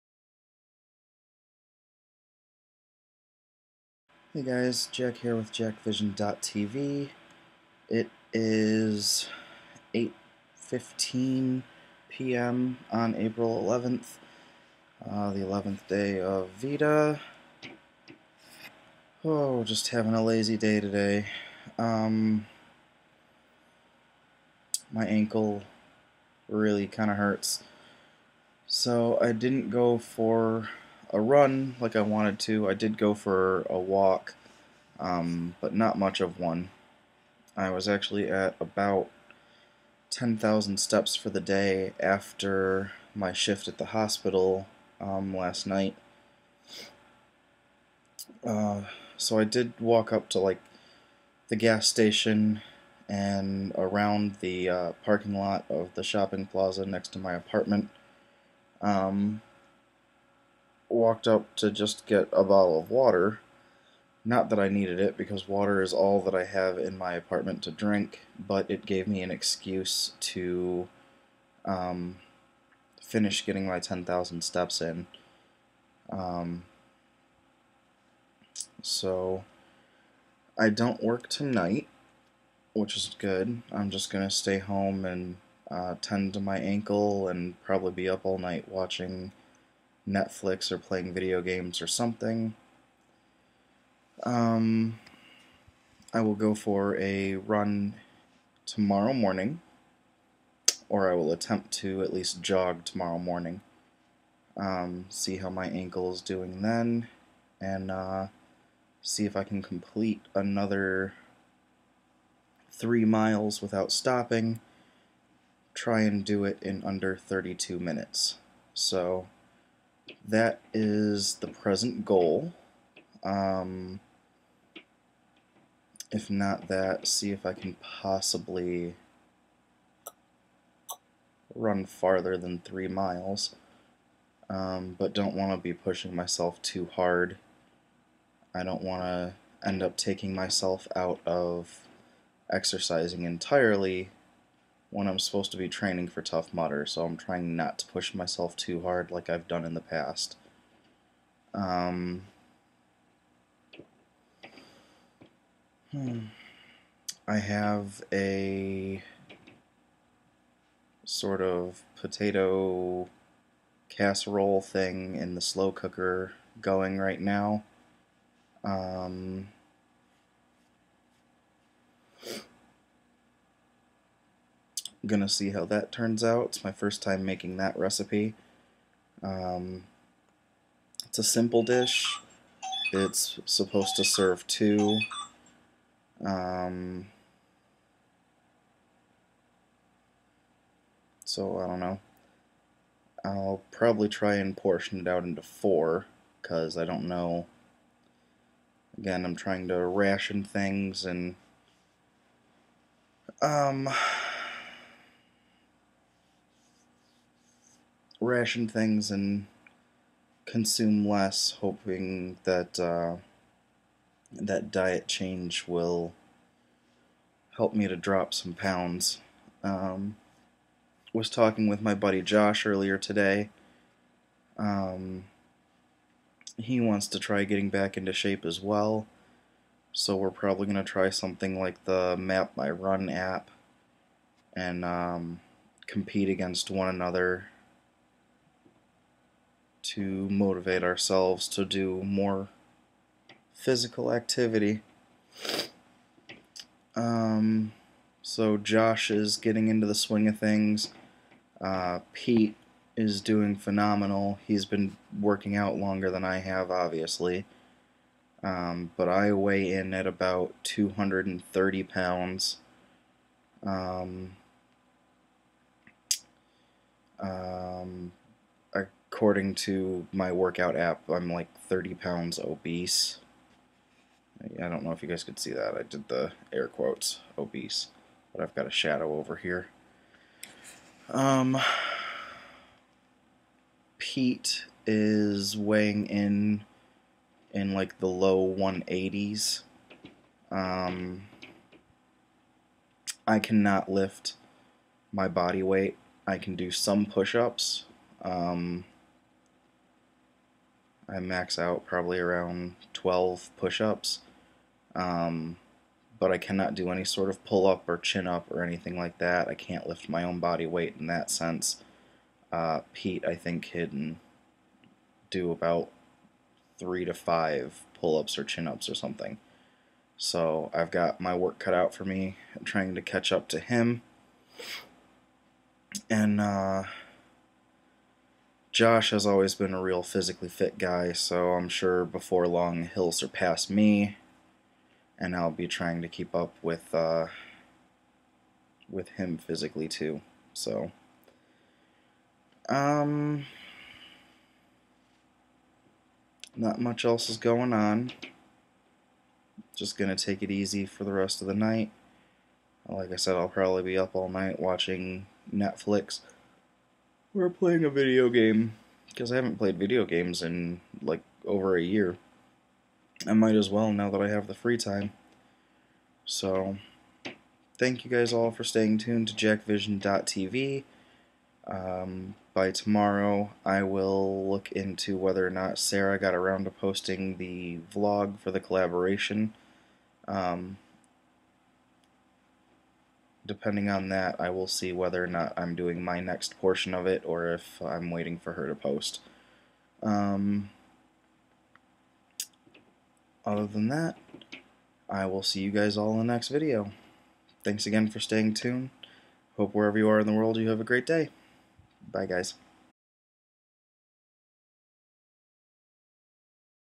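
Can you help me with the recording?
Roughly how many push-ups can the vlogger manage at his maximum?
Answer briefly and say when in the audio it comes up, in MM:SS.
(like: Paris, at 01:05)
12, at 05:02.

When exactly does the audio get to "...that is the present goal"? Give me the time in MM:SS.
02:00.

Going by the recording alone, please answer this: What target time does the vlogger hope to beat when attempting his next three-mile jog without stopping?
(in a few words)
32 minutes.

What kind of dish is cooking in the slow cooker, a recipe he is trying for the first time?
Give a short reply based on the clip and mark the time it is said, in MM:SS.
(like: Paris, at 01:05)
potato casserole, at 02:41.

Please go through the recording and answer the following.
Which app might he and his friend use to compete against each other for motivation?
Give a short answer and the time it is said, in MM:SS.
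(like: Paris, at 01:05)
Map My Run, at 03:52.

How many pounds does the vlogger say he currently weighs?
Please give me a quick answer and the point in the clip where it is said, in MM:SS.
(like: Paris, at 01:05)
230 pounds, at 04:20.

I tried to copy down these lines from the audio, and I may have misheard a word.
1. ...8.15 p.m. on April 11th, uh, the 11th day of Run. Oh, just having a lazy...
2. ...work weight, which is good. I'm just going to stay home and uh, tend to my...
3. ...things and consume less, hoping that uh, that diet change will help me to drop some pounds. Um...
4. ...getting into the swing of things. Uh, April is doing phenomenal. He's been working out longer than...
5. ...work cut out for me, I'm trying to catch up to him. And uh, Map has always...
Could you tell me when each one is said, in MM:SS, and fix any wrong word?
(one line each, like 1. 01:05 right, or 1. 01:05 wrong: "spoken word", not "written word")
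1. 00:09 wrong: "VEDA", not "Run"
2. 01:21 wrong: "tonight", not "weight"
3. 03:28 right
4. 04:09 wrong: "Pete", not "April"
5. 05:21 wrong: "Josh", not "Map".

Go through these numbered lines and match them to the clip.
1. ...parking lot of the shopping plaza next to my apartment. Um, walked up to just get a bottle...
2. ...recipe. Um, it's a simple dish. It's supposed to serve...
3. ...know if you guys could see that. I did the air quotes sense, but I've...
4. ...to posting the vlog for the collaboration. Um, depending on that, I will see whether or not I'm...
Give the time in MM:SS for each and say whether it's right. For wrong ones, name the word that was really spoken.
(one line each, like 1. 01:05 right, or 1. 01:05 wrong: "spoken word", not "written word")
1. 00:55 right
2. 02:57 right
3. 04:34 wrong: "obese", not "sense"
4. 06:16 right.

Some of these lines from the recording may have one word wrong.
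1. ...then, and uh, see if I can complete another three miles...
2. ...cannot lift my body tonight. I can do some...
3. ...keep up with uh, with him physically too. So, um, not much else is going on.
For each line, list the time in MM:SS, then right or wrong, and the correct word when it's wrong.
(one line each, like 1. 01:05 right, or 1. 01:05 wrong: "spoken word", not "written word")
1. 01:46 right
2. 04:53 wrong: "weight", not "tonight"
3. 05:36 right.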